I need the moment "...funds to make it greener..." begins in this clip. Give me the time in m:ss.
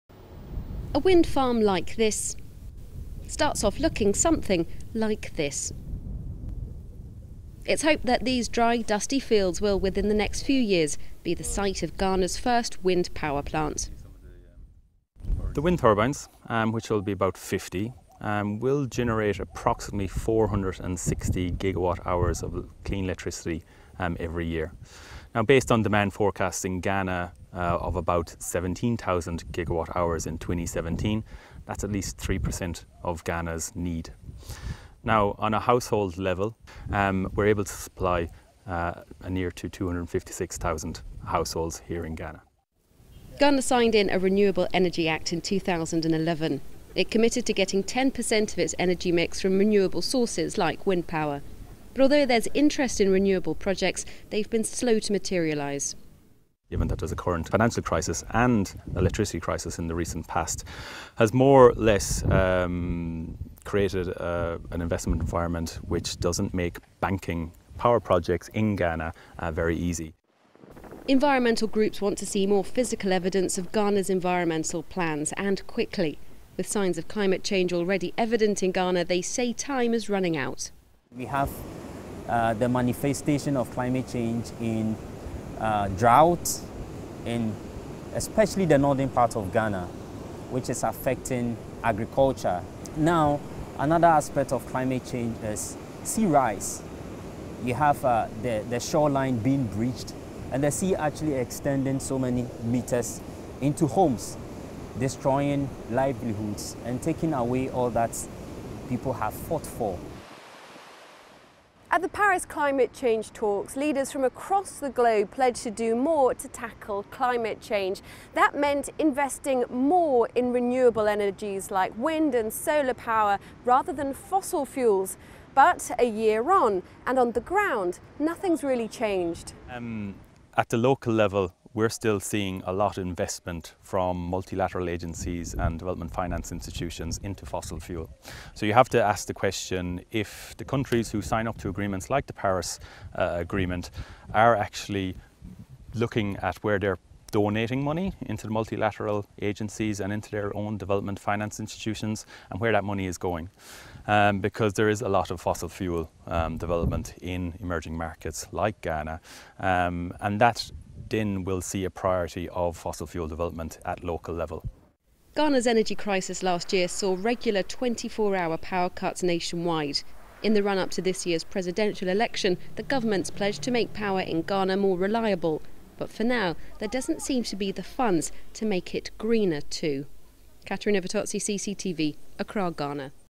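2:57.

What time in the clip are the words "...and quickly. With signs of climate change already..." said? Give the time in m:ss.
1:15.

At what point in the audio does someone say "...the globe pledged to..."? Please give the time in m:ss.
1:54.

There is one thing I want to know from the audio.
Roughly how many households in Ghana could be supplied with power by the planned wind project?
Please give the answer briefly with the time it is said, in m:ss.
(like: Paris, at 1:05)
256,000, at 0:39.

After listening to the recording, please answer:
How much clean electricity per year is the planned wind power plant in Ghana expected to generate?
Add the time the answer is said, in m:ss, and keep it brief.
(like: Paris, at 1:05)
460 gigawatt hours, at 0:20.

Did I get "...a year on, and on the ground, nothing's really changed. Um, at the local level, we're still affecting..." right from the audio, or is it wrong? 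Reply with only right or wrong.
wrong.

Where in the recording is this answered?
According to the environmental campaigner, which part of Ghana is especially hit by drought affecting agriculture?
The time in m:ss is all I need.
1:28.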